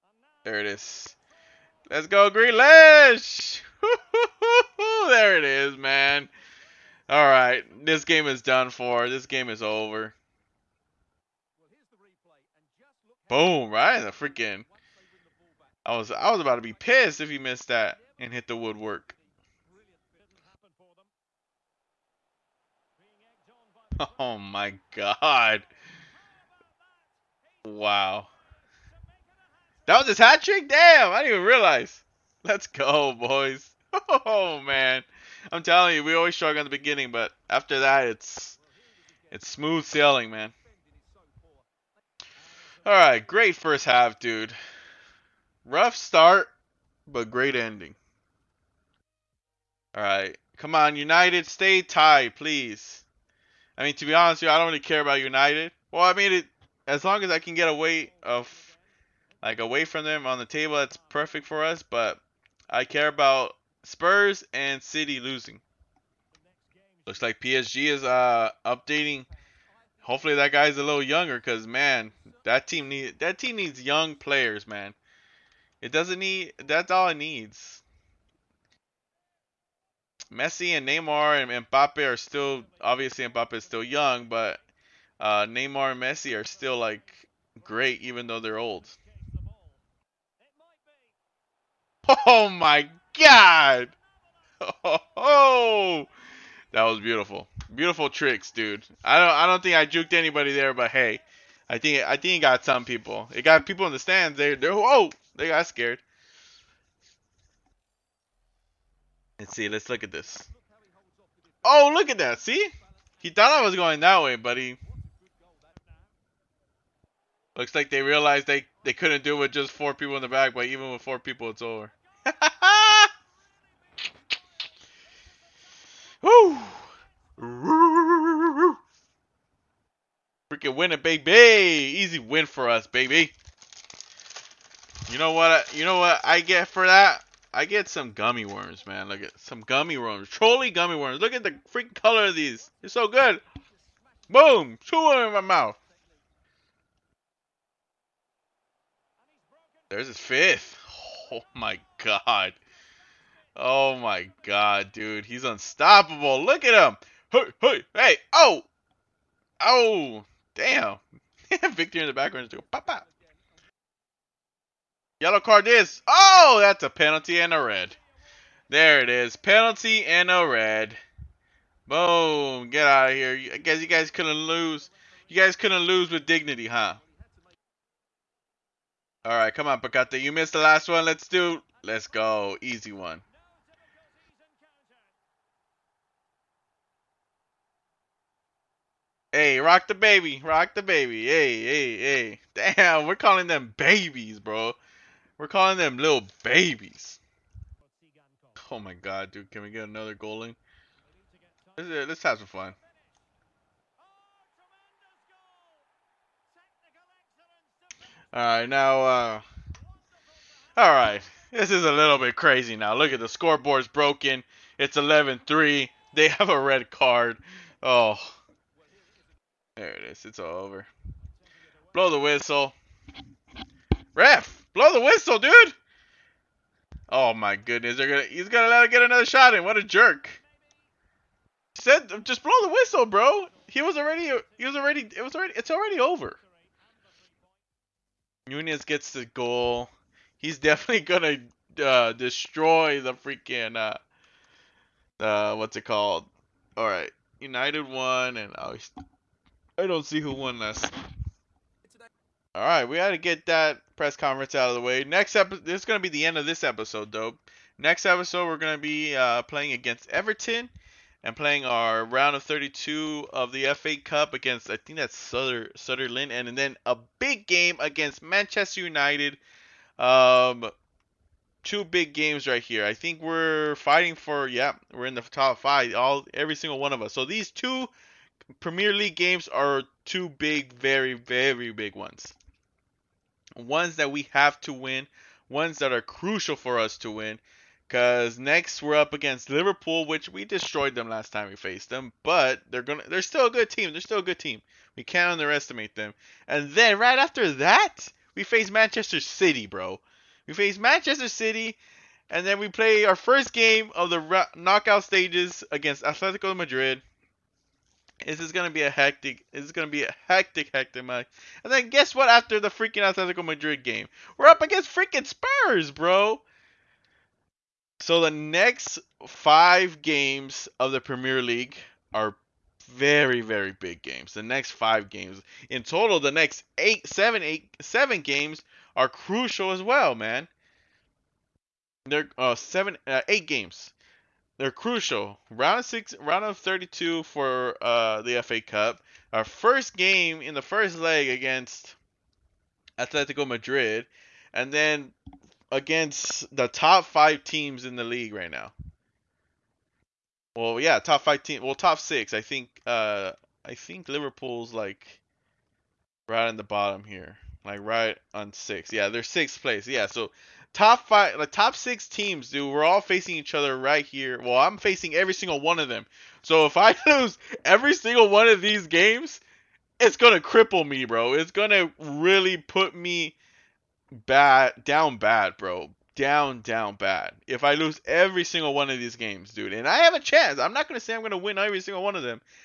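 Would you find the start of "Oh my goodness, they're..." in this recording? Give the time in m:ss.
3:47.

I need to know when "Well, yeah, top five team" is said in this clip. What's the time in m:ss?
5:50.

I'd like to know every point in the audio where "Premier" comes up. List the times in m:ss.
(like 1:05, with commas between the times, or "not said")
4:38, 5:20.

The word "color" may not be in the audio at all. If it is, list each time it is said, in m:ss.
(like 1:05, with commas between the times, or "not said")
2:21.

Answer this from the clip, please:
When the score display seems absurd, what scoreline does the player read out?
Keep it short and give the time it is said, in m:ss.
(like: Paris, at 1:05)
11-3, at 3:34.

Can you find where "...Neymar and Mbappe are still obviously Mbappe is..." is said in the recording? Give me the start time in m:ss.
1:20.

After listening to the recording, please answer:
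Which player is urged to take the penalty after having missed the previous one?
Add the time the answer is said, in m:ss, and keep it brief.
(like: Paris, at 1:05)
Paqueta, at 2:59.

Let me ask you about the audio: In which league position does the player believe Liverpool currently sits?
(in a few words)
Sixth.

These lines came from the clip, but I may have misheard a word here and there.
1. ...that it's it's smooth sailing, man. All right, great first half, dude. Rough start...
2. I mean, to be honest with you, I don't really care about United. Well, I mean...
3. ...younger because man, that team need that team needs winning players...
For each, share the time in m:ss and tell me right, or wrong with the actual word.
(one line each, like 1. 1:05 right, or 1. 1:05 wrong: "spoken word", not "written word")
1. 0:37 right
2. 0:53 right
3. 1:11 wrong: "young", not "winning".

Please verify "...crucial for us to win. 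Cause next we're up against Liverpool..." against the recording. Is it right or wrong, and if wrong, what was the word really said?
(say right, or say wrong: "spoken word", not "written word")
right.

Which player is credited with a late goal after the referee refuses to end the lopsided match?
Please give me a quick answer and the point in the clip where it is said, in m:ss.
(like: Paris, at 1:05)
Nunez, at 3:58.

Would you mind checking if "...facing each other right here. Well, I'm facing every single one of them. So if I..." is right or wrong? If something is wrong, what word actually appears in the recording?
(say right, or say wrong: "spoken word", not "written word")
right.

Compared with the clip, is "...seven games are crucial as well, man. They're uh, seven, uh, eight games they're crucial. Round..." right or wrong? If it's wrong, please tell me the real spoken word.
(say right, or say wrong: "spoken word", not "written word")
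right.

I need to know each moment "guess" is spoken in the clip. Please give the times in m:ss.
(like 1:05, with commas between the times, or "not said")
2:53, 5:11.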